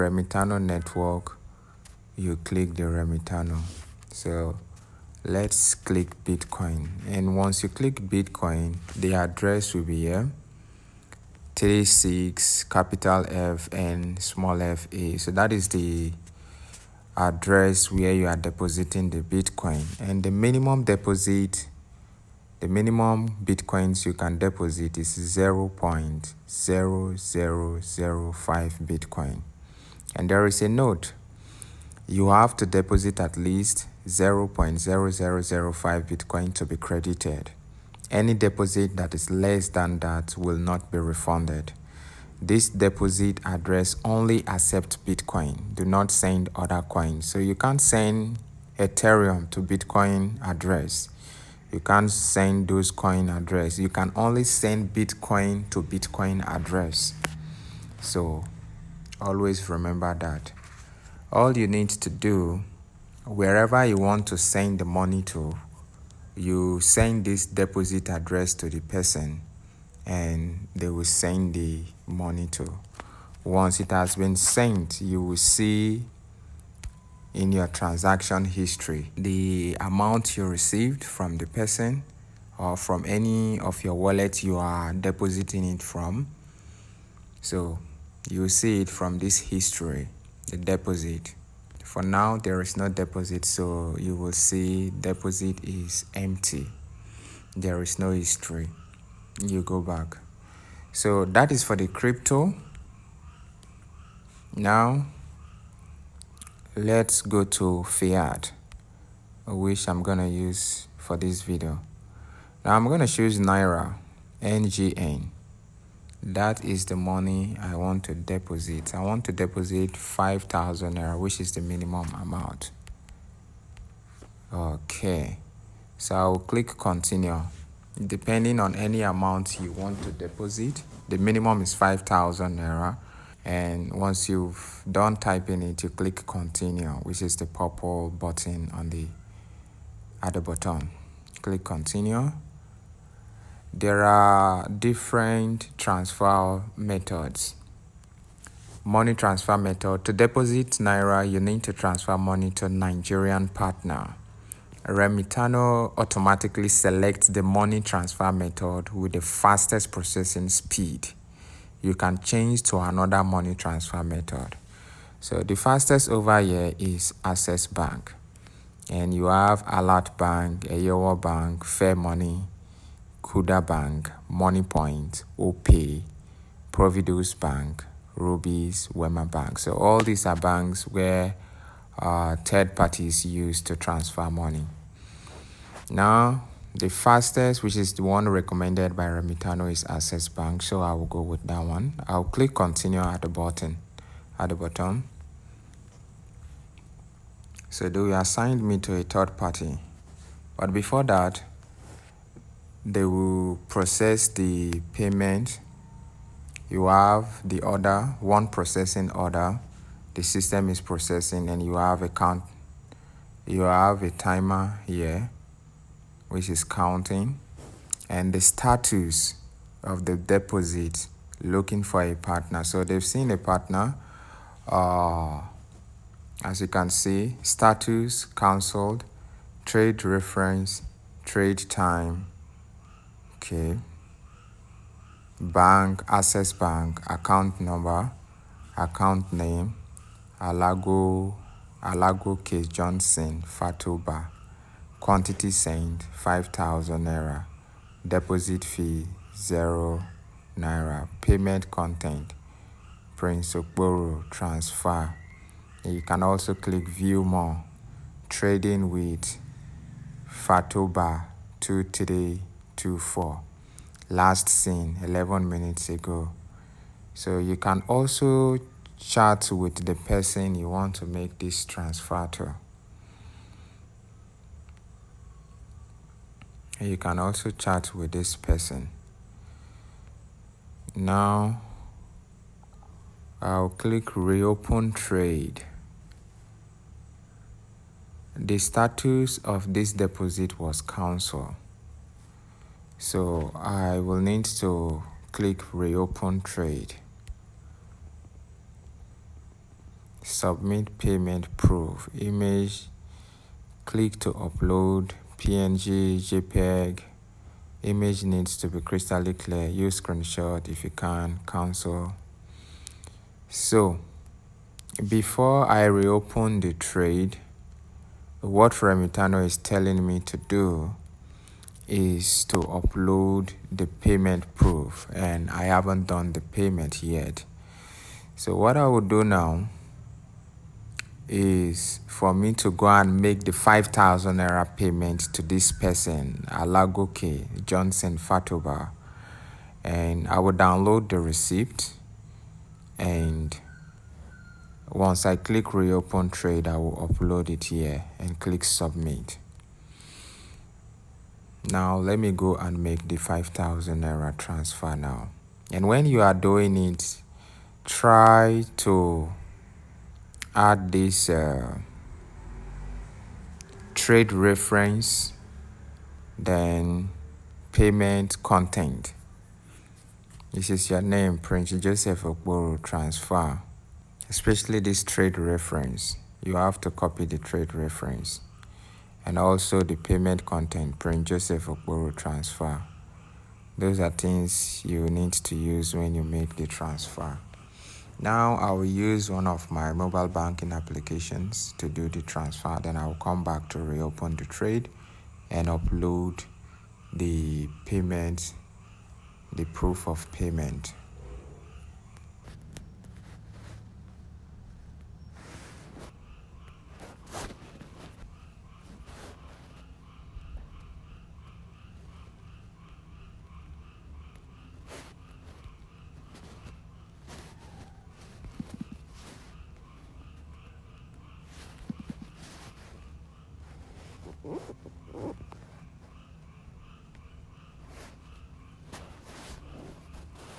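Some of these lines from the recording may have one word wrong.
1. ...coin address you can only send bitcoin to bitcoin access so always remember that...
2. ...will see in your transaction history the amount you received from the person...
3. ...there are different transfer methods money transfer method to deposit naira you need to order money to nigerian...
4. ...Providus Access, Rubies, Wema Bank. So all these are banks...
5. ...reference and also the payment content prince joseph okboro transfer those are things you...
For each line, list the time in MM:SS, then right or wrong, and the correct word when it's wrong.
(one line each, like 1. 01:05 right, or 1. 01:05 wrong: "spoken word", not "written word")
1. 00:52 wrong: "address", not "access"
2. 01:15 right
3. 02:23 wrong: "transfer", not "order"
4. 02:56 wrong: "Bank", not "Access"
5. 06:17 right.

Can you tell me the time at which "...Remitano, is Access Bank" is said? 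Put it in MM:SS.
03:09.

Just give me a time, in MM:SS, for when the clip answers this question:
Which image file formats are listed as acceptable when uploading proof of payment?
05:05.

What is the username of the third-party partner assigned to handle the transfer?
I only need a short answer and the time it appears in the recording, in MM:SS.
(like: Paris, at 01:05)
Fatoba 2324, at 04:20.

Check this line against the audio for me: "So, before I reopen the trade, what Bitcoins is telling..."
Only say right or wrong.
wrong.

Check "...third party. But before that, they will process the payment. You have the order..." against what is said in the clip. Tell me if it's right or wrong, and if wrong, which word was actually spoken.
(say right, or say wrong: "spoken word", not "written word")
right.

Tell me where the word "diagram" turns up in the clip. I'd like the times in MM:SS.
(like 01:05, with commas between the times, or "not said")
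not said.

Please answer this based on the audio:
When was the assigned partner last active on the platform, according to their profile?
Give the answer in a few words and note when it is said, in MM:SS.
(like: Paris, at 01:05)
11 minutes ago, at 04:25.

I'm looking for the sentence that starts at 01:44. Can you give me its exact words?
Now, let's go to Fiat, which I'm going to use for this video.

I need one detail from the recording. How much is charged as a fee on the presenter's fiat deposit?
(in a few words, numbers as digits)
0 naira.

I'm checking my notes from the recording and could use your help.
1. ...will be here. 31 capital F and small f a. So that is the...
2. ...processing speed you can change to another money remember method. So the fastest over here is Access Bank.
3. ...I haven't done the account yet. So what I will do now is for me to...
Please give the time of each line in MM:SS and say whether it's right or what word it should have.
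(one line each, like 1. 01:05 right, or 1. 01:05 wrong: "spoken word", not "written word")
1. 00:09 wrong: "36", not "31"
2. 02:39 wrong: "transfer", not "remember"
3. 05:25 wrong: "payment", not "account".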